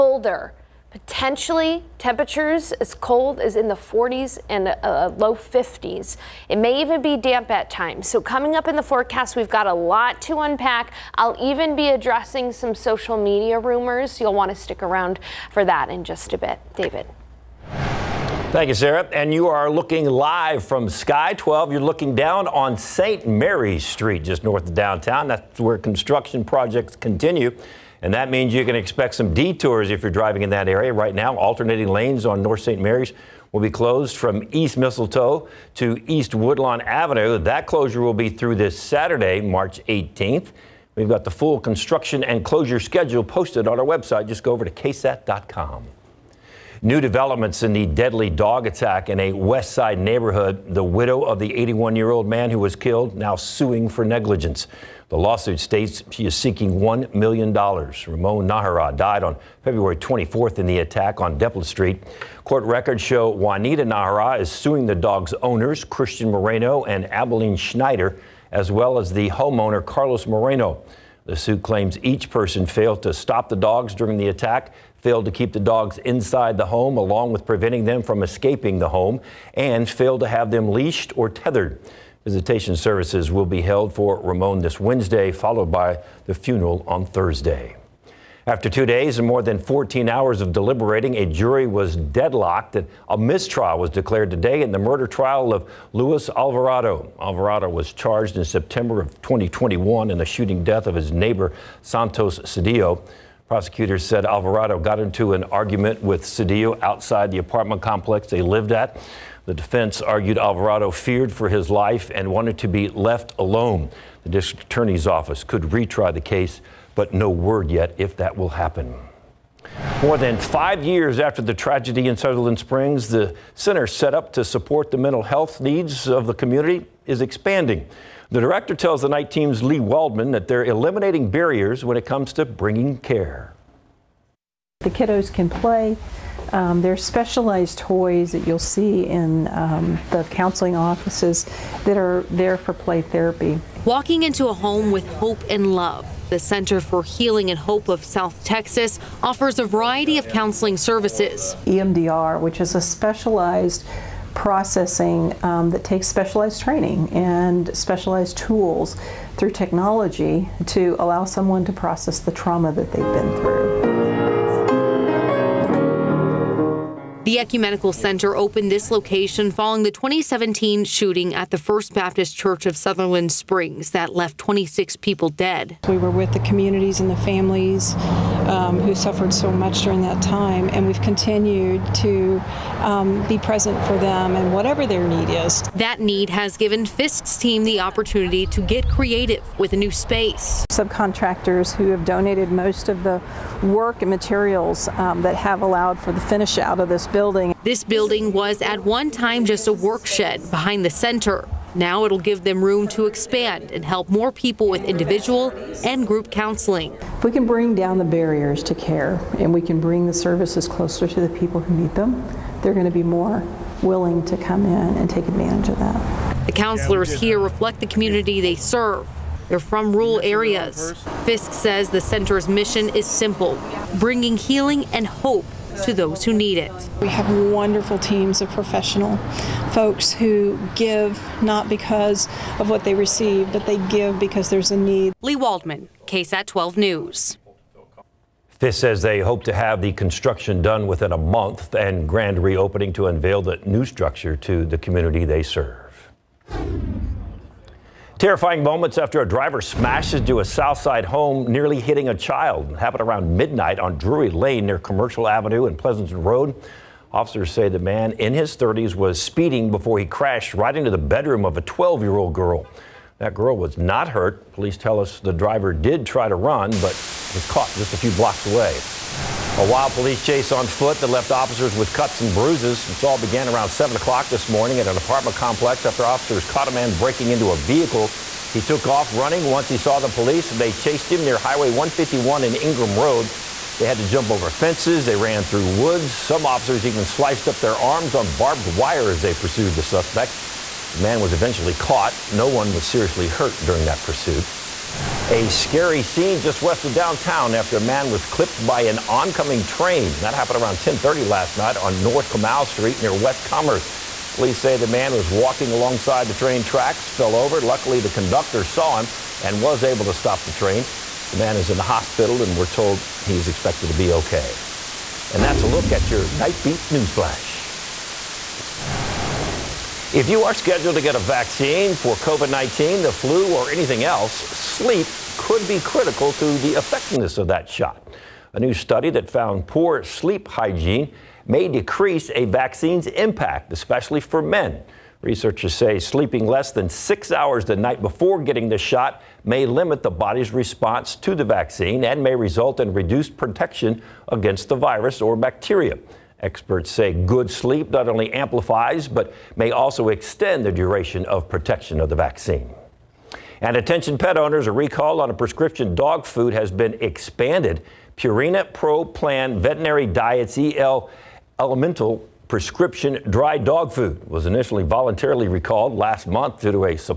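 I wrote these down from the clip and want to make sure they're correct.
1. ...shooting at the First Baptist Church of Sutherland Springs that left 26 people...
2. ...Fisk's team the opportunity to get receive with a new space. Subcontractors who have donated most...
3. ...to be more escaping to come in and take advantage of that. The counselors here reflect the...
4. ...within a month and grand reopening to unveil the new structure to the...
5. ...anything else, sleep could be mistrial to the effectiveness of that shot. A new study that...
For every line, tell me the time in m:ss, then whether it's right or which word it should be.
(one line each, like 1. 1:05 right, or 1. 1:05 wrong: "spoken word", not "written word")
1. 2:50 right
2. 3:06 wrong: "creative", not "receive"
3. 3:32 wrong: "willing", not "escaping"
4. 4:00 right
5. 5:23 wrong: "critical", not "mistrial".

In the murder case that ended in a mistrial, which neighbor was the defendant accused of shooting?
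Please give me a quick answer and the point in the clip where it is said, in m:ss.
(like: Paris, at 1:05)
Santos Cedillo, at 1:41.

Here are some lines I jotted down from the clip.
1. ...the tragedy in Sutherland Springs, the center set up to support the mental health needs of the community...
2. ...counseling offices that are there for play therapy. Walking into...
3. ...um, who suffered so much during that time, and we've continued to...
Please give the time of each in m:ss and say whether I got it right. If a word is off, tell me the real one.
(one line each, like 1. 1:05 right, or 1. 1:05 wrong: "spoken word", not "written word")
1. 2:01 right
2. 2:20 right
3. 2:58 right.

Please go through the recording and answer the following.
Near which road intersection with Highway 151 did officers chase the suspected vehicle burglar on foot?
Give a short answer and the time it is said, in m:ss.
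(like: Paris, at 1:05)
Ingram Road, at 4:42.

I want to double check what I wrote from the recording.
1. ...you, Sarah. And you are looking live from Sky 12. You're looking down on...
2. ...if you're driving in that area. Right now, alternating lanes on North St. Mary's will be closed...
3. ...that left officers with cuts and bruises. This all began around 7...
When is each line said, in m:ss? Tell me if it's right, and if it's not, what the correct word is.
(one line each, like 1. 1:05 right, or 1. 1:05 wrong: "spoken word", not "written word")
1. 0:18 right
2. 0:29 right
3. 4:31 right.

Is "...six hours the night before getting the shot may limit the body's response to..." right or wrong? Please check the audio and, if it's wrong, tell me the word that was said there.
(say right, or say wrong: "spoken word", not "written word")
right.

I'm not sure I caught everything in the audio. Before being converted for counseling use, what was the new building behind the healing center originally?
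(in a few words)
a work shed.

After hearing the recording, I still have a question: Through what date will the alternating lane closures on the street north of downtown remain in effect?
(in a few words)
March 18th.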